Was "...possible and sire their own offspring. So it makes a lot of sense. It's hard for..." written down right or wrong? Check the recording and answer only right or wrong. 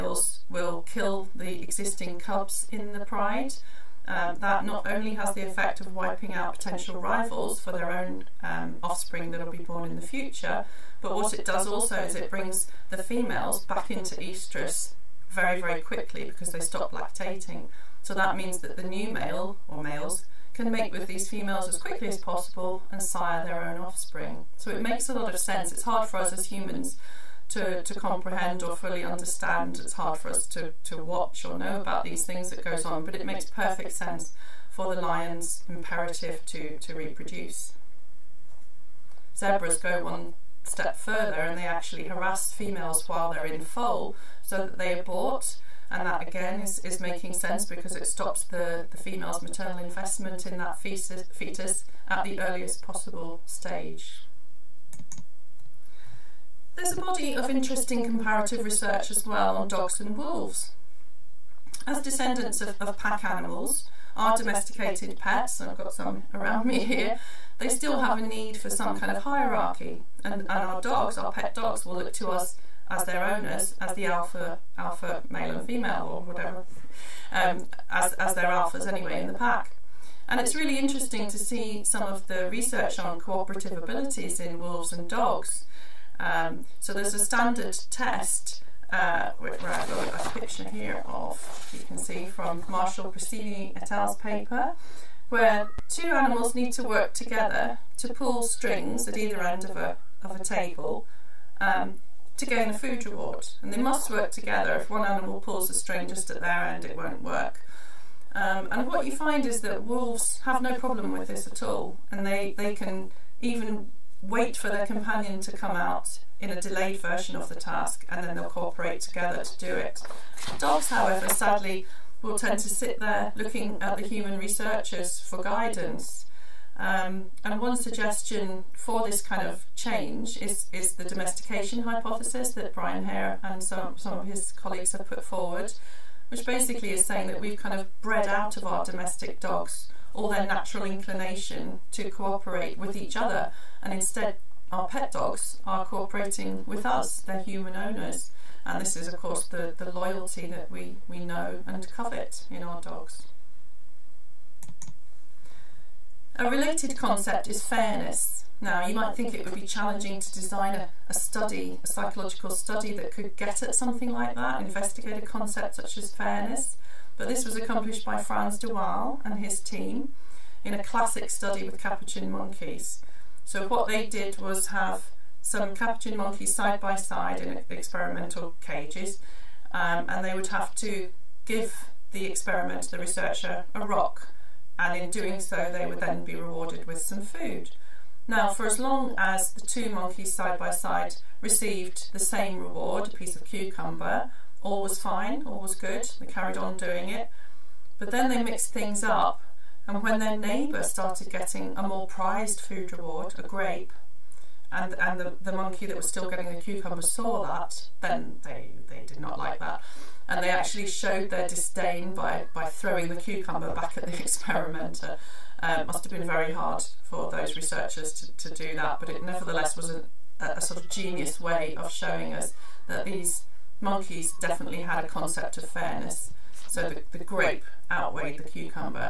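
right.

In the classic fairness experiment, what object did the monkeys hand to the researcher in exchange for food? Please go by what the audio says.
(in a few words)
A rock.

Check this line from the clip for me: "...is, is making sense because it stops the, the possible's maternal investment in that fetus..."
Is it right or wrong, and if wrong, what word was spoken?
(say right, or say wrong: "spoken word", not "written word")
wrong: "female", not "possible".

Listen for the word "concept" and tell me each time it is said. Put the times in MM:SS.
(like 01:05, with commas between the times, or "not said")
02:36, 02:45, 03:45.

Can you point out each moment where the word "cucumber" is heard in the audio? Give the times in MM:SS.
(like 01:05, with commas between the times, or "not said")
03:13, 03:26, 03:33, 03:48.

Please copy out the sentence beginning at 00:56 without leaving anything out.
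There's a body of interesting comparative research as well on dogs and wolves.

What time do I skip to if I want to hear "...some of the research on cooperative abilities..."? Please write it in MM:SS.
01:21.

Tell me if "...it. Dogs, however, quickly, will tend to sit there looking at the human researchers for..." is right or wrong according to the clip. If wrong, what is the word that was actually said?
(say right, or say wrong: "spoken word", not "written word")
wrong: "sadly", not "quickly".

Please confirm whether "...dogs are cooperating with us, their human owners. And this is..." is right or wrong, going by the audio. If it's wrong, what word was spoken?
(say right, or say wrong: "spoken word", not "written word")
right.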